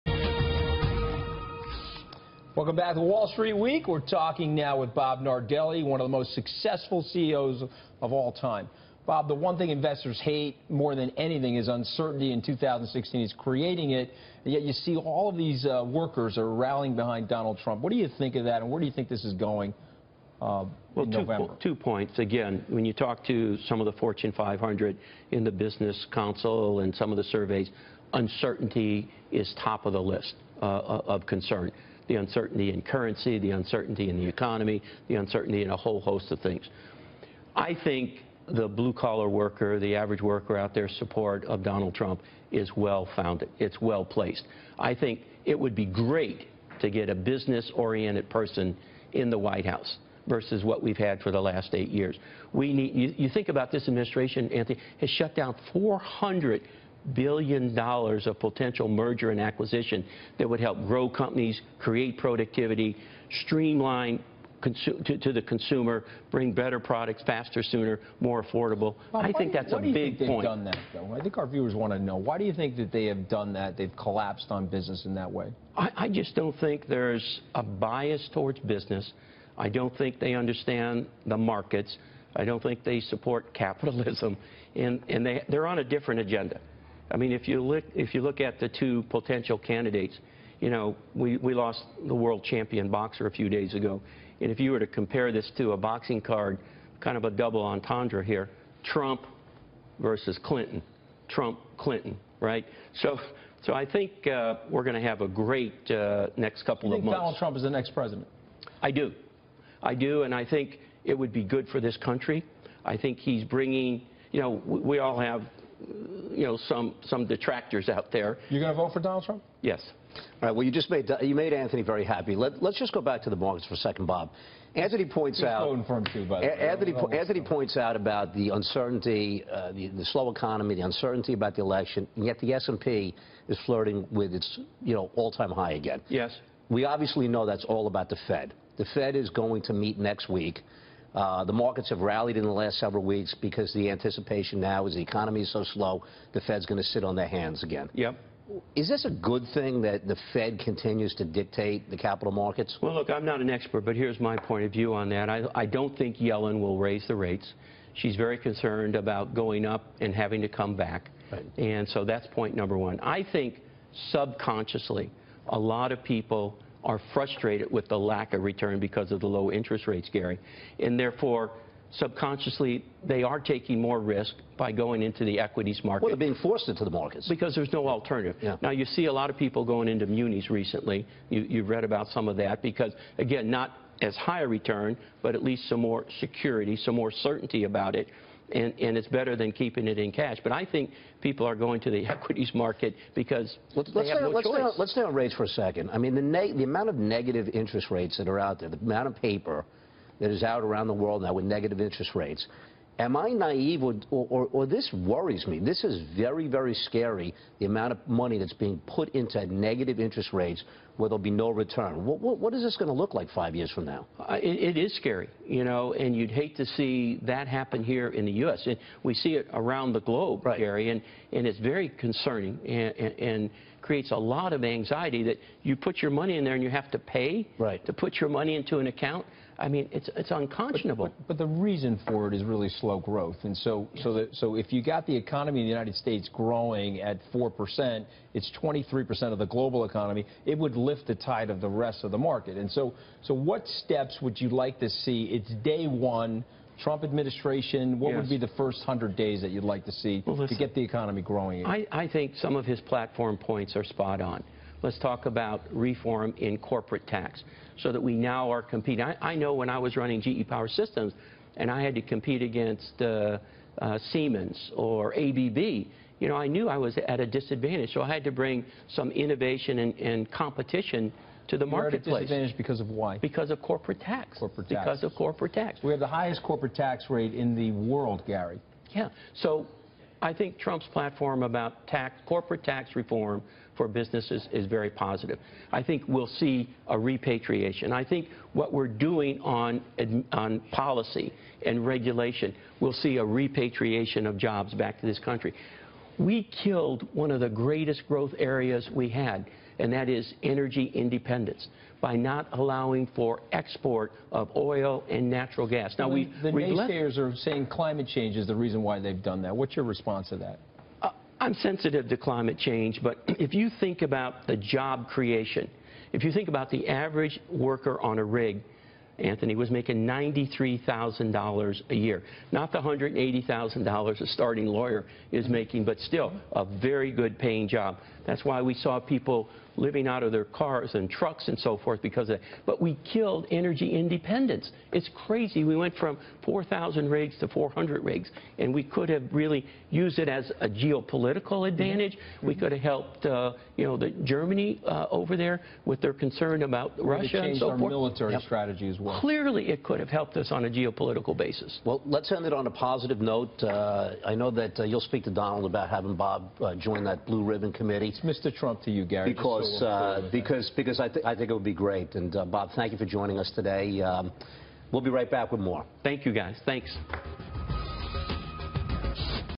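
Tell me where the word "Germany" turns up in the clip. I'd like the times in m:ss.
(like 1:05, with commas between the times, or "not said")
5:44.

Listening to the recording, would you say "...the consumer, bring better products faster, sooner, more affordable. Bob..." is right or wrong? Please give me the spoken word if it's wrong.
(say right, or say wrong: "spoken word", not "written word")
right.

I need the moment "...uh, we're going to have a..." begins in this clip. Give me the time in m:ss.
1:44.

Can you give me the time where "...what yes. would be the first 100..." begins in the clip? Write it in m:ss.
4:07.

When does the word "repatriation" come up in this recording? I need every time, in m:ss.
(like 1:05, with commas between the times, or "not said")
4:46, 4:53.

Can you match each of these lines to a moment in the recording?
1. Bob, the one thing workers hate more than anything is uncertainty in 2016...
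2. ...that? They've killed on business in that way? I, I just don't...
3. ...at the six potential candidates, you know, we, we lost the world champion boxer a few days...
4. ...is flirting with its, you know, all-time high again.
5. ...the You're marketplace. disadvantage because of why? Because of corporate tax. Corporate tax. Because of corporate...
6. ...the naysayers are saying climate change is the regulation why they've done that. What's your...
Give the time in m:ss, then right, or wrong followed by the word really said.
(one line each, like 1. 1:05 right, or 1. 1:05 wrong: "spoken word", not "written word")
1. 0:09 wrong: "investors", not "workers"
2. 1:13 wrong: "collapsed", not "killed"
3. 1:28 wrong: "two", not "six"
4. 2:13 right
5. 4:31 right
6. 5:06 wrong: "reason", not "regulation".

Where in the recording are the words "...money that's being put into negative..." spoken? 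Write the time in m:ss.
3:28.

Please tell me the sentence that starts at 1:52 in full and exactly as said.
I think he's bringing, you know, we all have you know, some, some detractors out there.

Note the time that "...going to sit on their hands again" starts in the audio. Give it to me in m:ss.
2:26.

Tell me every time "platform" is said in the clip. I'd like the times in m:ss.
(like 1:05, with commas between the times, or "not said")
4:12, 4:40.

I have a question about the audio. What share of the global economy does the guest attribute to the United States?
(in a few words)
23%.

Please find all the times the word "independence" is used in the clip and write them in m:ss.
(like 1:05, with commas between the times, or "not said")
5:00, 5:33.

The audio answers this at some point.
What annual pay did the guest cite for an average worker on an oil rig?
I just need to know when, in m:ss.
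5:20.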